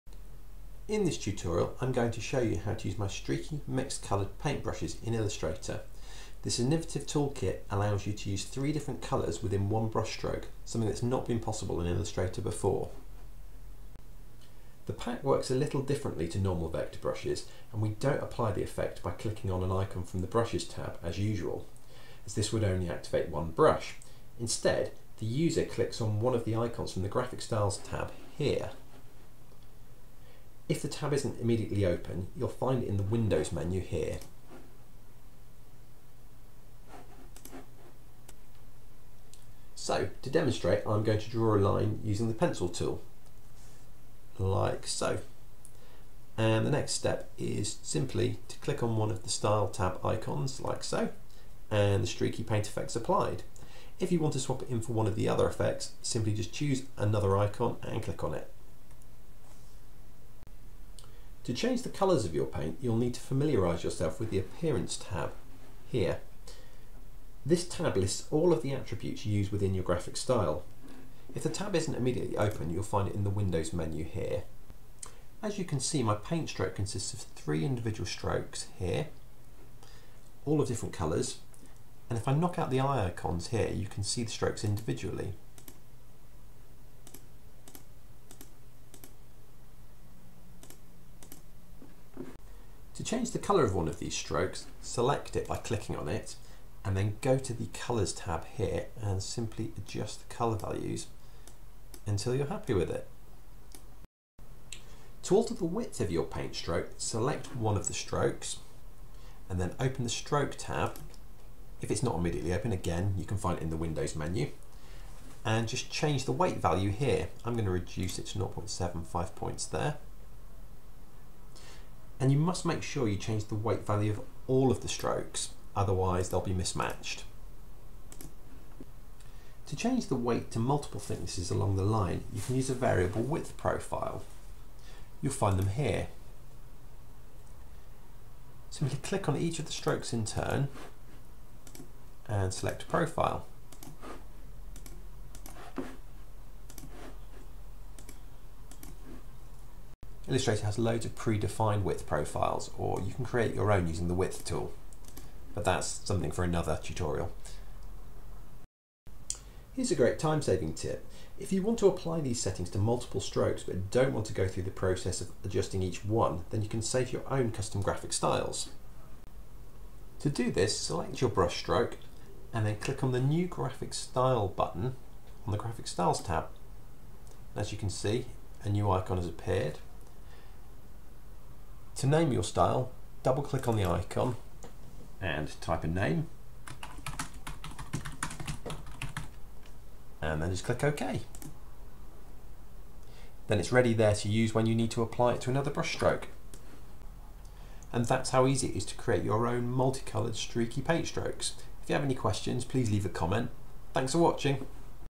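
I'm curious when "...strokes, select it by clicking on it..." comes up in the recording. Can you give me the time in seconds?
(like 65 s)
94 s.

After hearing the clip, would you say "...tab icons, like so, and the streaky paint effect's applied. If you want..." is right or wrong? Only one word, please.
right.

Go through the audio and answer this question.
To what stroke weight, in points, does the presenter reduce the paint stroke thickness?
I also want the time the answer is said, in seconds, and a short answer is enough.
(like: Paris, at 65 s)
0.75, at 118 s.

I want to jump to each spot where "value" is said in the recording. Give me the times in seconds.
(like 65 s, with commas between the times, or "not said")
100 s, 116 s, 123 s.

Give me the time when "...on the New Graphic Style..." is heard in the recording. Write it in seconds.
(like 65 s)
173 s.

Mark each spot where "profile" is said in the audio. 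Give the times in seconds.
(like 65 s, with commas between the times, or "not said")
133 s, 142 s, 152 s.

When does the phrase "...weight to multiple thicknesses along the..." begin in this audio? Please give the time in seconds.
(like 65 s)
130 s.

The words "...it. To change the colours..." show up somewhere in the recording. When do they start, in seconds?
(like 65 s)
58 s.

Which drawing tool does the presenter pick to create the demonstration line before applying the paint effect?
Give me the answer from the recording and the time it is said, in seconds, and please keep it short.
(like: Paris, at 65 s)
pencil tool, at 42 s.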